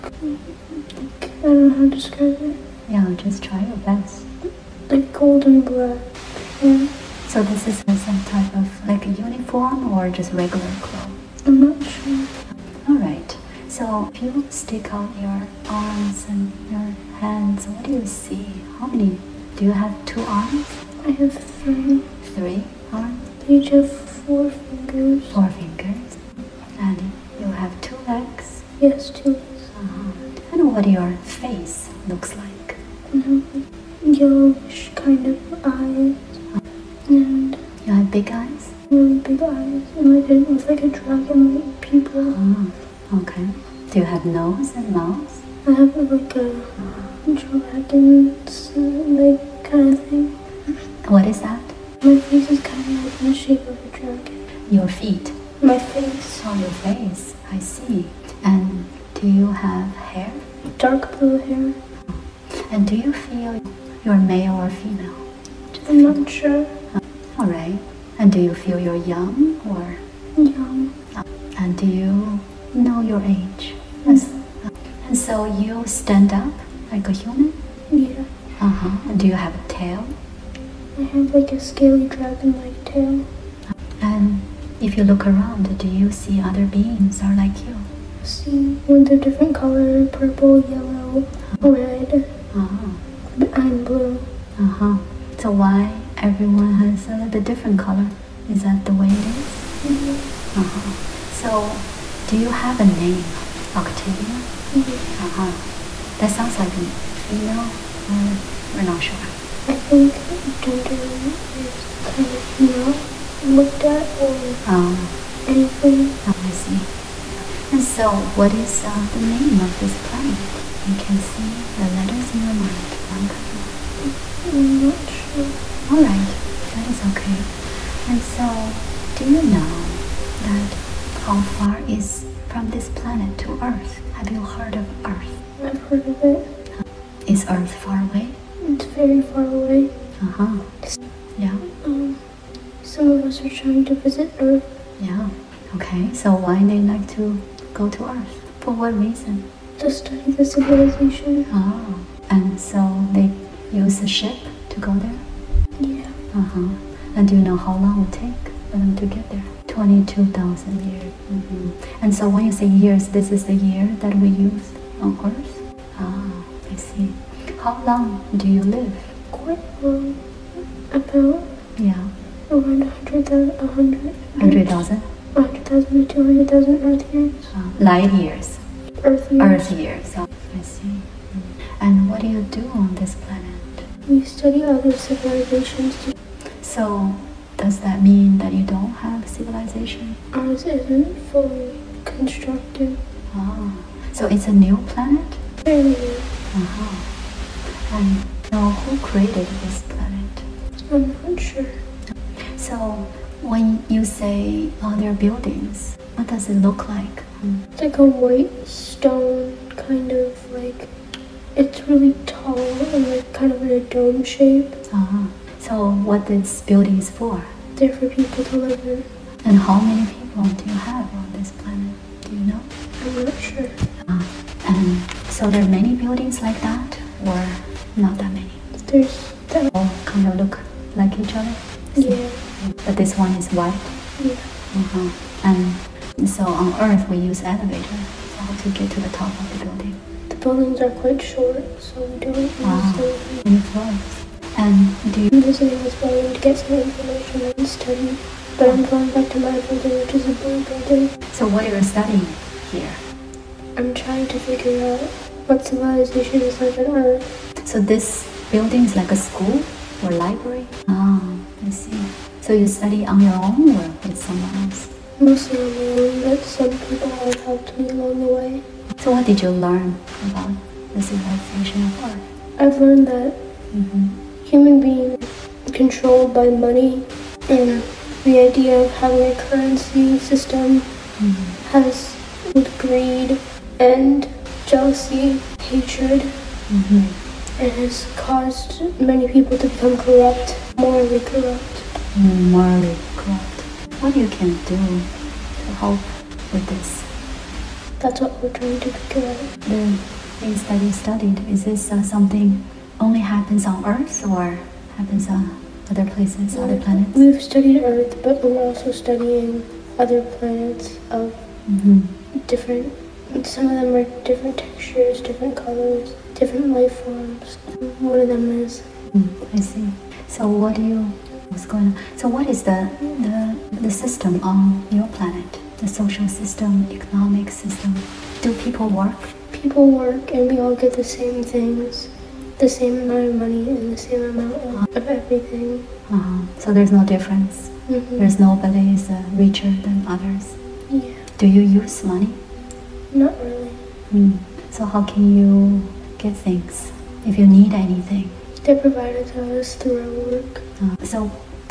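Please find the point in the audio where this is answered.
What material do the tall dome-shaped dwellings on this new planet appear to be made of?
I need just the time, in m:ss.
3:28.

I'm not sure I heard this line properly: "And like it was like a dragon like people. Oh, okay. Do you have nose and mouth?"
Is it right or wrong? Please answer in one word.
right.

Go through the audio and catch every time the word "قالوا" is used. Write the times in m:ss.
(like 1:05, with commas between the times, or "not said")
not said.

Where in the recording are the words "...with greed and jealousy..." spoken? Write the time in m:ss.
4:42.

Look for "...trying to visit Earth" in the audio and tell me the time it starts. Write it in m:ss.
2:23.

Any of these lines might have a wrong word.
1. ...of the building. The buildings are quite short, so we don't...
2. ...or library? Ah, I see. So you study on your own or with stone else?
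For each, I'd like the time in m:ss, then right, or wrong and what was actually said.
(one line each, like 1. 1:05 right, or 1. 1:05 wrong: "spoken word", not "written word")
1. 3:59 right
2. 4:20 wrong: "someone", not "stone".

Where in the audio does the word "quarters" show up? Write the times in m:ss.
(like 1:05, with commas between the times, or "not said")
not said.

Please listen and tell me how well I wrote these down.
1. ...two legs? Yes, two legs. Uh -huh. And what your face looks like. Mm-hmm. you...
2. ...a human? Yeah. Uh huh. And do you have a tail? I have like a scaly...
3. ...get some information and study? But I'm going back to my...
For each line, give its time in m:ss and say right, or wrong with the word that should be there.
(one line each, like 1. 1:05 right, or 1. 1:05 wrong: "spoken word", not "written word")
1. 0:27 right
2. 1:17 right
3. 4:06 right.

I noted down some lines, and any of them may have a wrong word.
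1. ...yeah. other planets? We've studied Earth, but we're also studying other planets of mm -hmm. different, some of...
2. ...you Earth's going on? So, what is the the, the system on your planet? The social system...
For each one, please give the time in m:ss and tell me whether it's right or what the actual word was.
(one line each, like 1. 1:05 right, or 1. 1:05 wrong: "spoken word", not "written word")
1. 5:06 right
2. 5:20 wrong: "What", not "Earth".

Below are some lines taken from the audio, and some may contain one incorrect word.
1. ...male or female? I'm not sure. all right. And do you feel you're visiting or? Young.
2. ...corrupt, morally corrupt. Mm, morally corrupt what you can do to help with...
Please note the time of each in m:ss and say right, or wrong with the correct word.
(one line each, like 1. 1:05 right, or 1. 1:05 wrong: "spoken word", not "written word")
1. 1:04 wrong: "young", not "visiting"
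2. 4:50 right.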